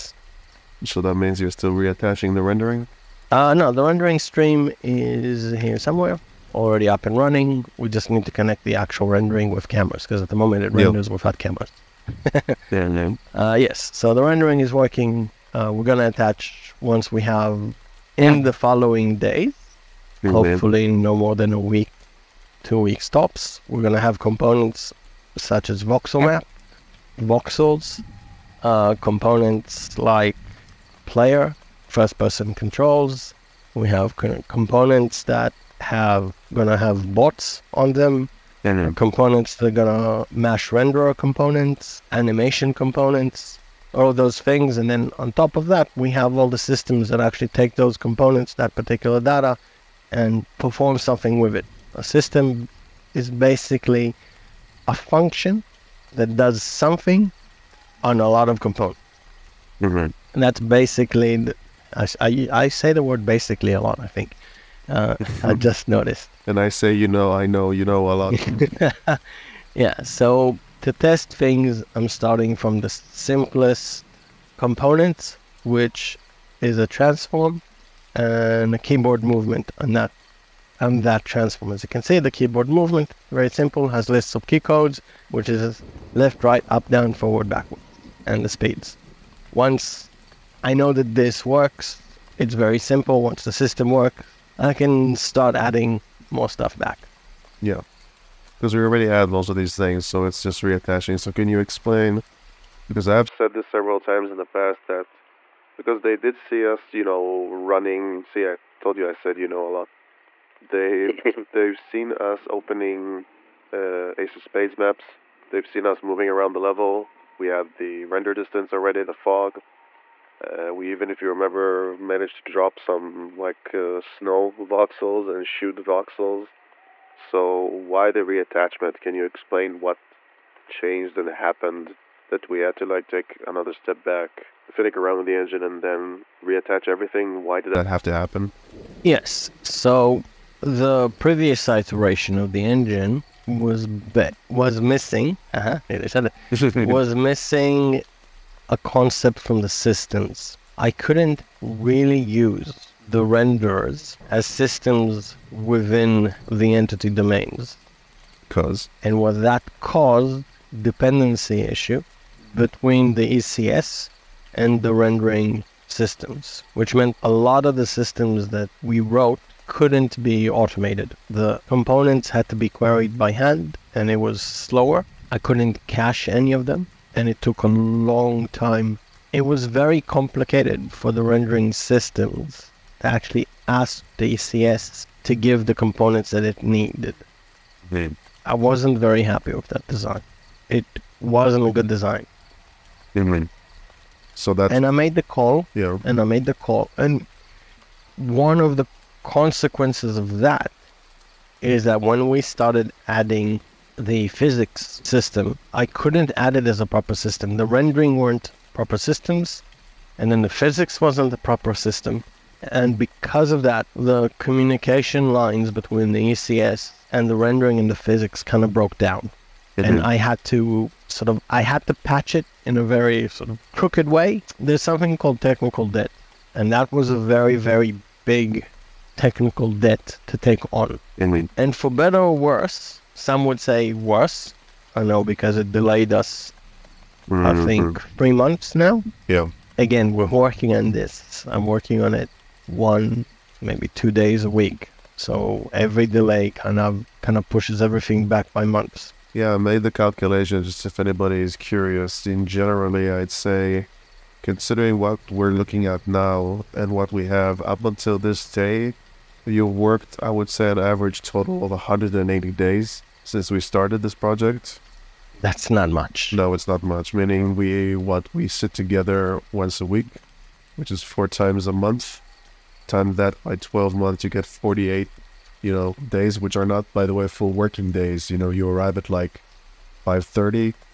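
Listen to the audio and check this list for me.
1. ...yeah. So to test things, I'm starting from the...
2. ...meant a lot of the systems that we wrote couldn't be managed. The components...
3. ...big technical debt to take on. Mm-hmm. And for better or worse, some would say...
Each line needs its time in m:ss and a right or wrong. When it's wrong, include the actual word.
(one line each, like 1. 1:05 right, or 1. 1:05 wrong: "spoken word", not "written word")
1. 1:09 right
2. 2:46 wrong: "automated", not "managed"
3. 3:48 right.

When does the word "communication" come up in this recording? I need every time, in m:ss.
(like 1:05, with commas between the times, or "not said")
3:34.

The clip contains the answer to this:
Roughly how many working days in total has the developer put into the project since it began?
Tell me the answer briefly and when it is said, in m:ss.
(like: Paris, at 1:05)
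180, at 4:21.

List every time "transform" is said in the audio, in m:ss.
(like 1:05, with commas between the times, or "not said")
1:16, 1:21.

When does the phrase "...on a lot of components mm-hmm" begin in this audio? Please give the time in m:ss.
0:58.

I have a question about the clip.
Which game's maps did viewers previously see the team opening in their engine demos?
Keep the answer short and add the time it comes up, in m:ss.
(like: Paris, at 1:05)
Ace of Spades, at 1:54.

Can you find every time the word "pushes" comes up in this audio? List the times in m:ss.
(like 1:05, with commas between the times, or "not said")
4:07.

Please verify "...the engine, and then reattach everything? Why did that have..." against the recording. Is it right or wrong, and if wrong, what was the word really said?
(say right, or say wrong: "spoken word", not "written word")
right.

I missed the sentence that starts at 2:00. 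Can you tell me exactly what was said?
Uh, we even, if you remember, managed to drop some like uh, snow voxels and shoot voxels.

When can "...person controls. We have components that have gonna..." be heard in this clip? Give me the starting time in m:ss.
0:32.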